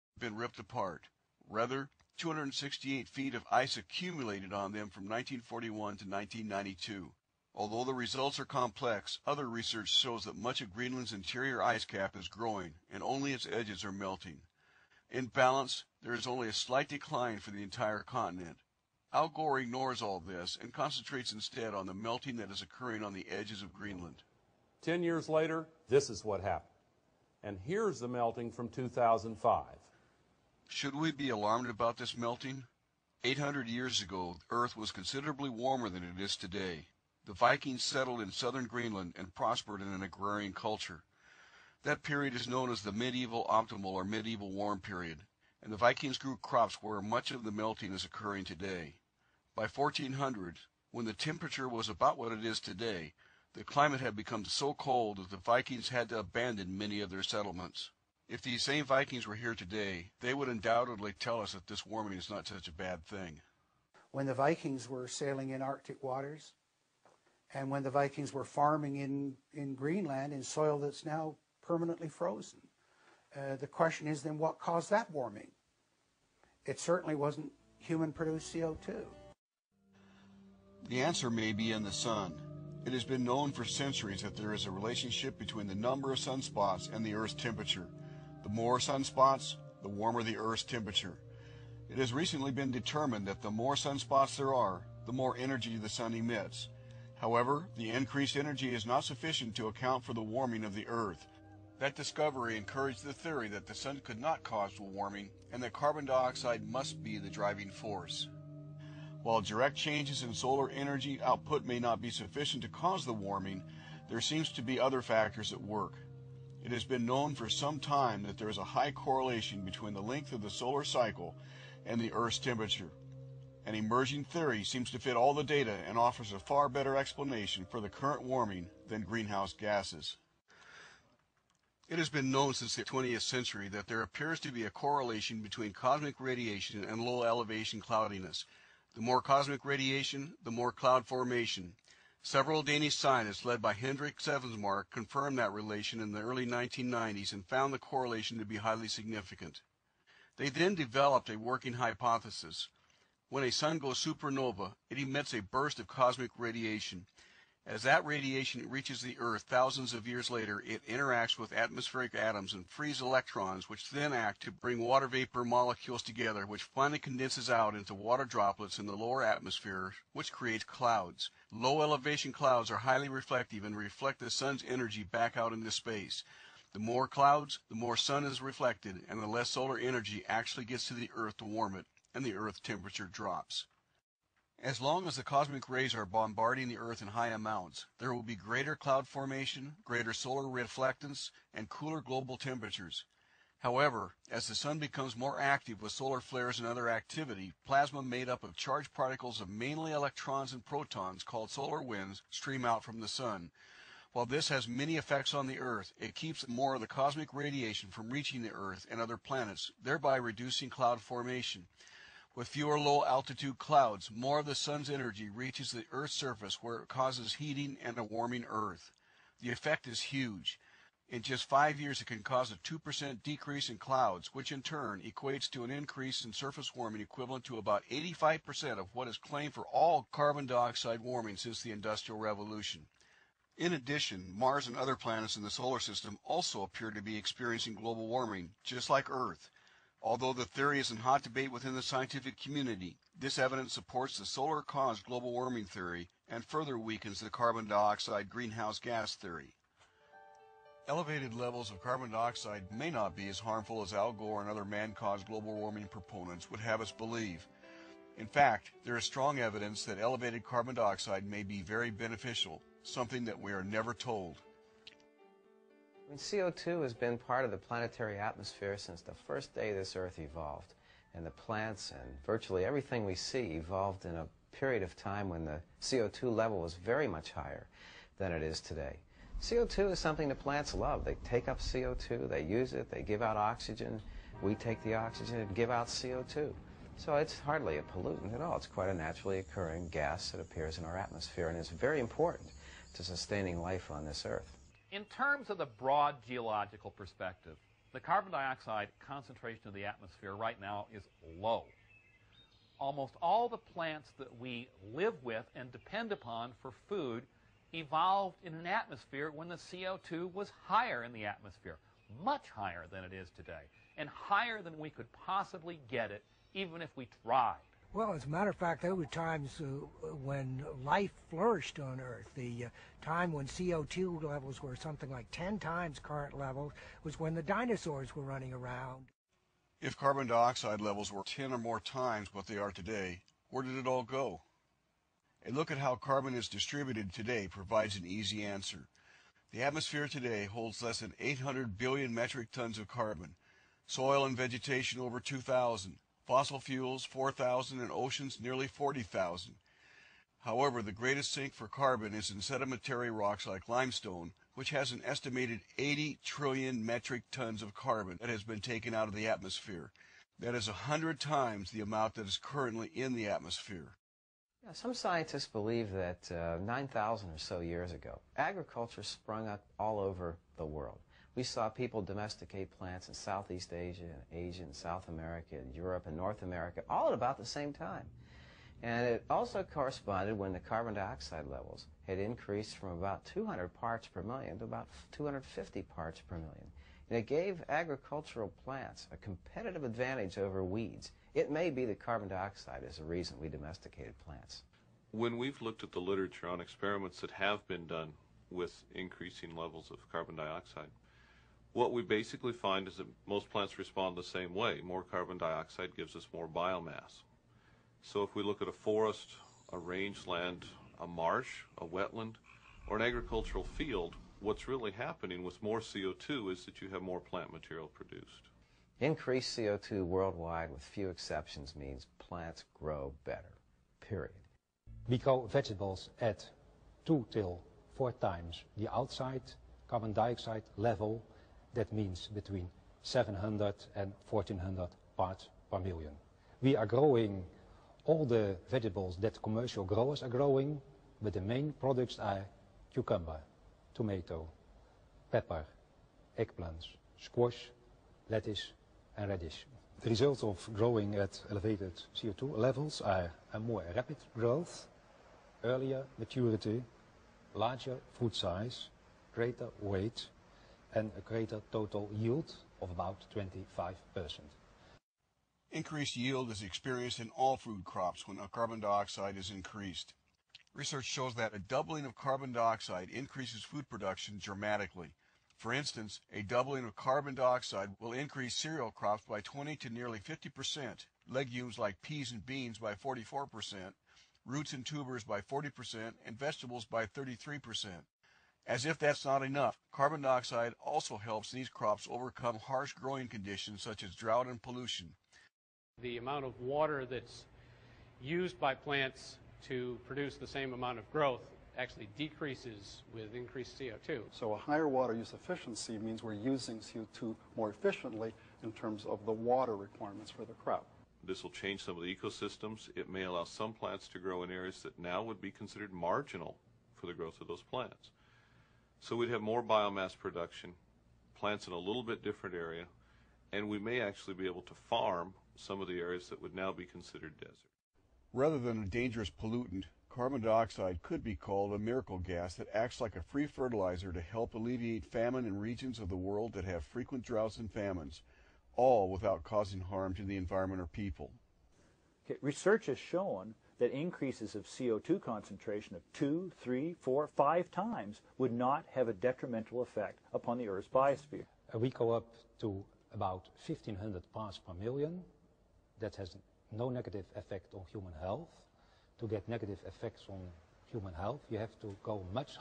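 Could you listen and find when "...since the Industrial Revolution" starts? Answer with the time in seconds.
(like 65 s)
231 s.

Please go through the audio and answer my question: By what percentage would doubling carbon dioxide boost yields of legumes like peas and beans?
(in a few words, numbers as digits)
44%.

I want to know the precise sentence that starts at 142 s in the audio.
Several Danish scientists led by Henrik Svensmark confirmed that relation in the early 1990s and found the correlation to be highly significant.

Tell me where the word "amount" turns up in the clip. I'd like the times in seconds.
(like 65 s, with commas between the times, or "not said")
187 s, 361 s, 496 s, 500 s.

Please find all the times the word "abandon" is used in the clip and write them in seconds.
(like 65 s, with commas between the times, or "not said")
56 s.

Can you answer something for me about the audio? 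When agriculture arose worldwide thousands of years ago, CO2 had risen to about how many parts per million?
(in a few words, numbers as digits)
250.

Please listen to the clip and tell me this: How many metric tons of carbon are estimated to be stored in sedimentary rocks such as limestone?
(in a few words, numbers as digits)
80 trillion.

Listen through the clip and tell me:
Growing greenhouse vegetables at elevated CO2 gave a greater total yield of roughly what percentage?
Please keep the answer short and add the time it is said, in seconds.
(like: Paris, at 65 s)
25%, at 463 s.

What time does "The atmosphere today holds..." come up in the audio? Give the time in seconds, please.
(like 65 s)
339 s.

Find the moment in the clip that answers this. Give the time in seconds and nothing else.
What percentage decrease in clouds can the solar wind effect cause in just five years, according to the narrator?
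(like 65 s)
222 s.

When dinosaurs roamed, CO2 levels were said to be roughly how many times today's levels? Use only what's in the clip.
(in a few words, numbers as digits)
10 times.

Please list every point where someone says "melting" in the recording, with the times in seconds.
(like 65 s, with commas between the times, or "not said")
13 s, 21 s, 28 s, 32 s, 47 s.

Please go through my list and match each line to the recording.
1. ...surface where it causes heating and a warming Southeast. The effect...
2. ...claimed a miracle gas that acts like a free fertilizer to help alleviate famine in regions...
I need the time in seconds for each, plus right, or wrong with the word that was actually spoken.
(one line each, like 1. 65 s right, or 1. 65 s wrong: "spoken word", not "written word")
1. 216 s wrong: "Earth", not "Southeast"
2. 531 s wrong: "called", not "claimed".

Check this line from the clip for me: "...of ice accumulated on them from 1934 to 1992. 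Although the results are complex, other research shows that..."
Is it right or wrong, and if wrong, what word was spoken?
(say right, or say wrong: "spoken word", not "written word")
wrong: "1941", not "1934".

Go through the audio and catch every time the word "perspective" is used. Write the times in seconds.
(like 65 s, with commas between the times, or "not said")
296 s.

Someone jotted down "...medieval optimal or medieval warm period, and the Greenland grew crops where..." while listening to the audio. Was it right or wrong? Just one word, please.
wrong.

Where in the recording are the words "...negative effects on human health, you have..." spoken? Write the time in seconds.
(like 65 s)
559 s.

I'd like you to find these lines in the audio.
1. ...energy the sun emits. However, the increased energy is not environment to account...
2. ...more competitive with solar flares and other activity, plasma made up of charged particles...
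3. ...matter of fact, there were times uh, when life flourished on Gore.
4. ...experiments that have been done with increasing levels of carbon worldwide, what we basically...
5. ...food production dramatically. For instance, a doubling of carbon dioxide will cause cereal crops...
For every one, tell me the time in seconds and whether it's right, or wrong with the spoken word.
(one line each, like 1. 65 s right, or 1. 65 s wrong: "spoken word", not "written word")
1. 95 s wrong: "sufficient", not "environment"
2. 195 s wrong: "active", not "competitive"
3. 318 s wrong: "Earth", not "Gore"
4. 396 s wrong: "dioxide", not "worldwide"
5. 473 s wrong: "increase", not "cause".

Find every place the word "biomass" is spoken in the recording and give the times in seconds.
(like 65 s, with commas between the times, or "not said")
406 s, 519 s.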